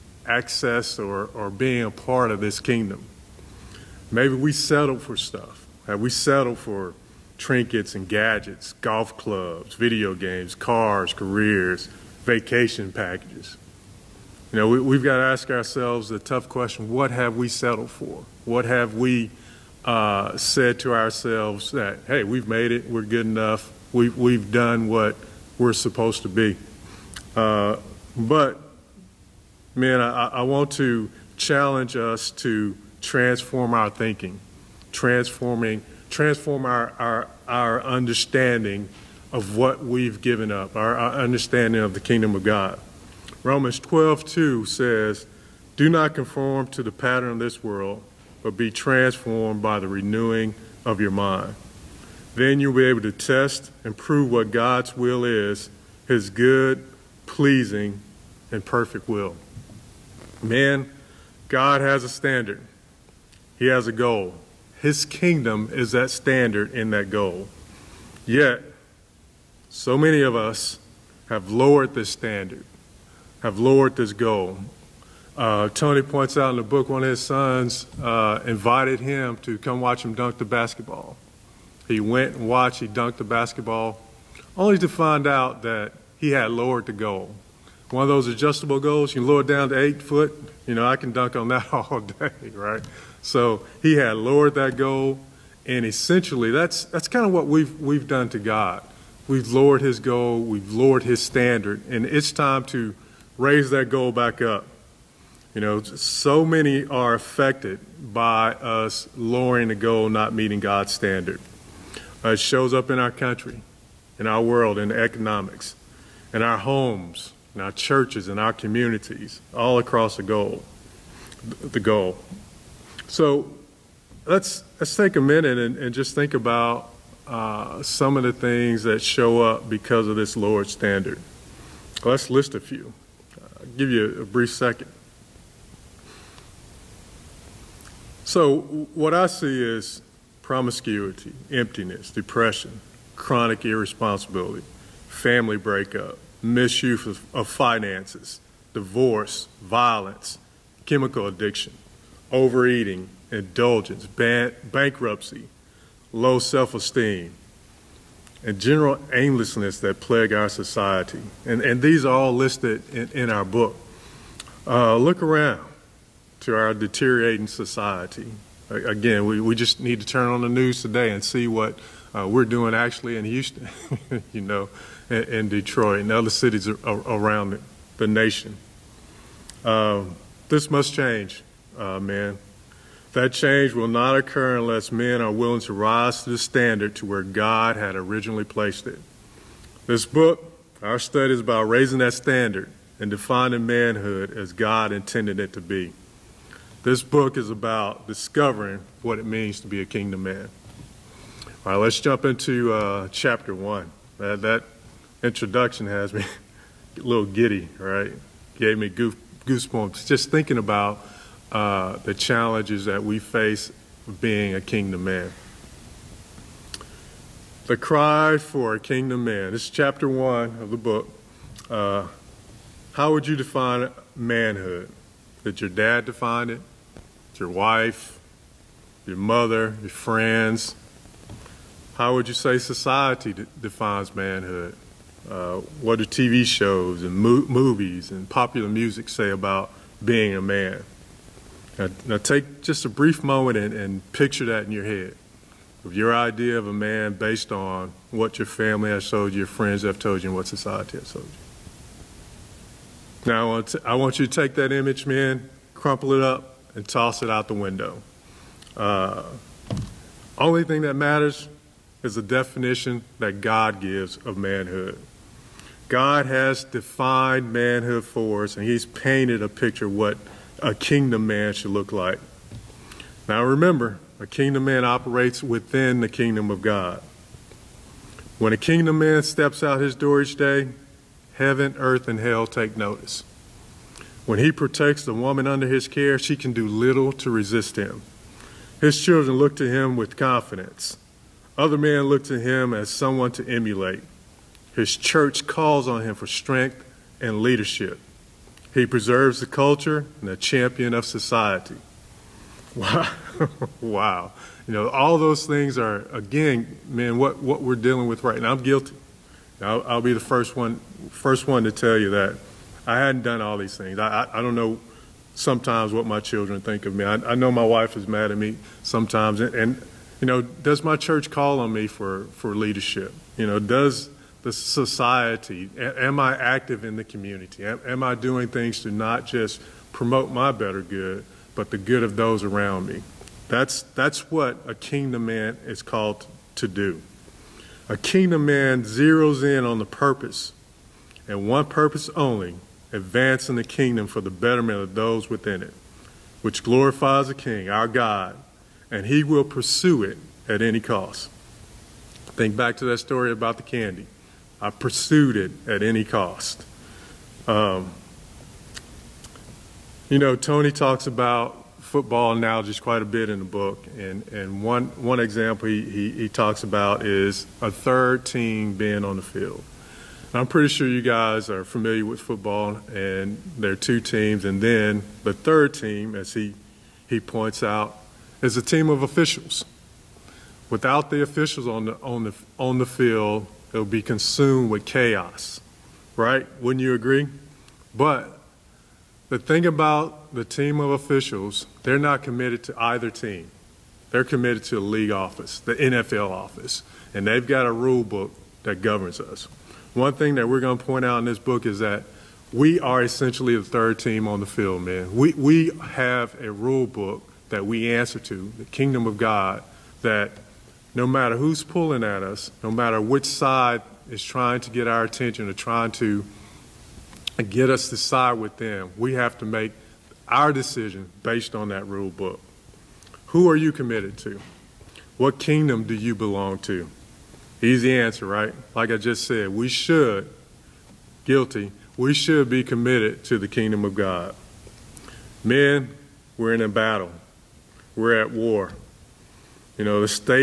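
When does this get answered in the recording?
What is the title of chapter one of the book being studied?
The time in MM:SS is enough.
03:37.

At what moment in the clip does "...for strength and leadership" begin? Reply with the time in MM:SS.
04:56.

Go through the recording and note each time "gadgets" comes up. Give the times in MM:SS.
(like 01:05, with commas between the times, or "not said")
00:08.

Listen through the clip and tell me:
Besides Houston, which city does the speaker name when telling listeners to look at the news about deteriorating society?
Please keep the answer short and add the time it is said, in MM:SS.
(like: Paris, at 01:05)
Detroit, at 02:55.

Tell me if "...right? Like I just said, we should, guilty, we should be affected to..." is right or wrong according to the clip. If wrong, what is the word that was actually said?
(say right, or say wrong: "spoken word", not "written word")
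wrong: "committed", not "affected".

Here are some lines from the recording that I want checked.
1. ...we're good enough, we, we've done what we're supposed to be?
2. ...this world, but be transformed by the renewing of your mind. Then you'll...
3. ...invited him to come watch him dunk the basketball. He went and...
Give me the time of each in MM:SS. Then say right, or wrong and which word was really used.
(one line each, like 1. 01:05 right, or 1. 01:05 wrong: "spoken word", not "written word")
1. 00:22 right
2. 00:47 right
3. 01:18 right.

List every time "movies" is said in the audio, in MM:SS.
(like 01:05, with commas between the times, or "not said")
03:57.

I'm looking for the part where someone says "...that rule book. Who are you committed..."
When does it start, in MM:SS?
07:01.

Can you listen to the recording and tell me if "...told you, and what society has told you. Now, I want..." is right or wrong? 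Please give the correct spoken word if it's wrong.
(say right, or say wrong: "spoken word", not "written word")
right.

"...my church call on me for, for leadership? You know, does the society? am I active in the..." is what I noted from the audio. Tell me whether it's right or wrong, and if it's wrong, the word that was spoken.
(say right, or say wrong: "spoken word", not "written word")
right.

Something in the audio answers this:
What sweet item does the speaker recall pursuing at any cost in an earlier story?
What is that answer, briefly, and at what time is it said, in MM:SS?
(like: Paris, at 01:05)
candy, at 05:53.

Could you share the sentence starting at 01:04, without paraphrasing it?
His kingdom is that standard and that goal.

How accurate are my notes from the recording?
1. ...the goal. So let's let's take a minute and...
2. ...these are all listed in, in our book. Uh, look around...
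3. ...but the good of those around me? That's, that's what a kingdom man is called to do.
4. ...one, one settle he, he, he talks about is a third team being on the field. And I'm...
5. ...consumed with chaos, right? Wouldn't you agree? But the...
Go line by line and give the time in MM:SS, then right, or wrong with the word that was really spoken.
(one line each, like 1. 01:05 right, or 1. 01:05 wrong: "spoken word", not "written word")
1. 02:01 right
2. 02:41 right
3. 05:31 right
4. 06:04 wrong: "example", not "settle"
5. 06:24 right.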